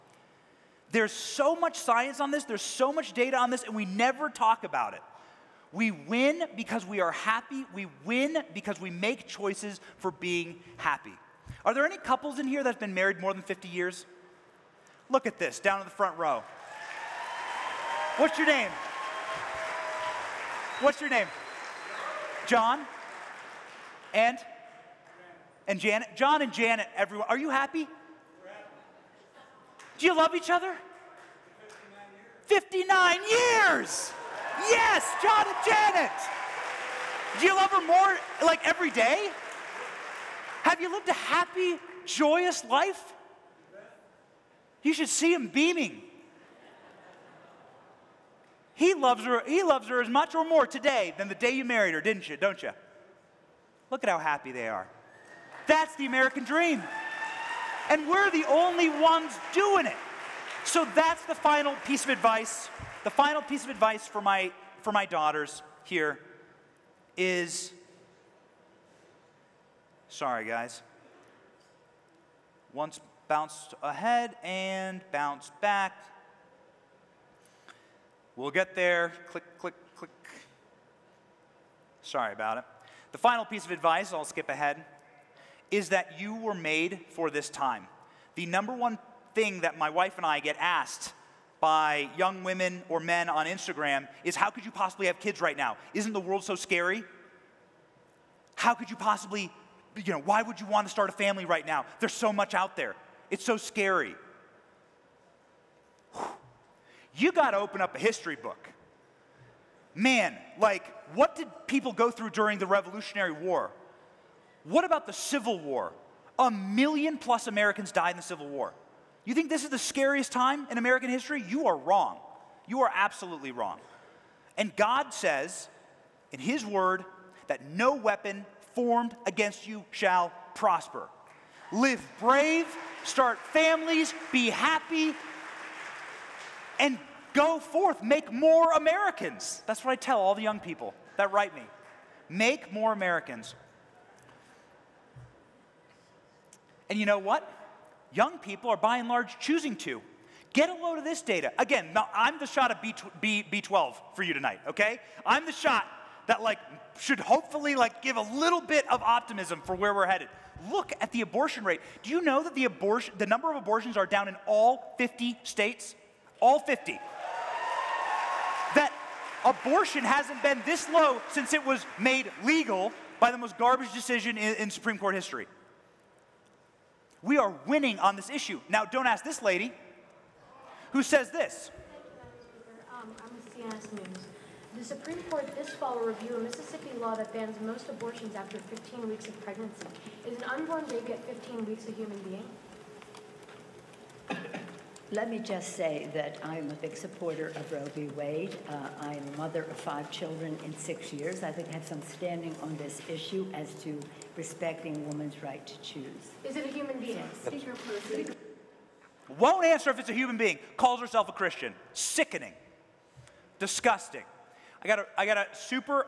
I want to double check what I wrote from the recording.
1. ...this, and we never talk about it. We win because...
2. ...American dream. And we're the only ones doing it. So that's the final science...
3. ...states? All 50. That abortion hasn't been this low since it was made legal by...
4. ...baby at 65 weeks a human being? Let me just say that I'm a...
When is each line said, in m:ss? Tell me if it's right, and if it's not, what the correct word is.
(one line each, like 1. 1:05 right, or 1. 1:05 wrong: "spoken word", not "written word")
1. 0:03 right
2. 0:56 wrong: "piece", not "science"
3. 2:45 right
4. 3:10 wrong: "15", not "65".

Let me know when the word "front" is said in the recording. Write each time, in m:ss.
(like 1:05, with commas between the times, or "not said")
0:15.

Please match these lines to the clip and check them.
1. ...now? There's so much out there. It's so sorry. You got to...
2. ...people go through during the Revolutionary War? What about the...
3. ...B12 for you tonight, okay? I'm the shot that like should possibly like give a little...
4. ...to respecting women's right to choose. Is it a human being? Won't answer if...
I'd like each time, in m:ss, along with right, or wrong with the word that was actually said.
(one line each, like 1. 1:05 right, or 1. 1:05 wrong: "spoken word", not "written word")
1. 1:41 wrong: "scary", not "sorry"
2. 1:51 right
3. 2:33 wrong: "hopefully", not "possibly"
4. 3:23 right.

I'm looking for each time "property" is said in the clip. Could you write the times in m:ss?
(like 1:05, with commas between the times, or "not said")
not said.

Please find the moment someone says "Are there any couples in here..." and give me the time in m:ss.
0:11.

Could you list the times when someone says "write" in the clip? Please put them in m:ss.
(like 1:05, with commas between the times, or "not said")
2:21.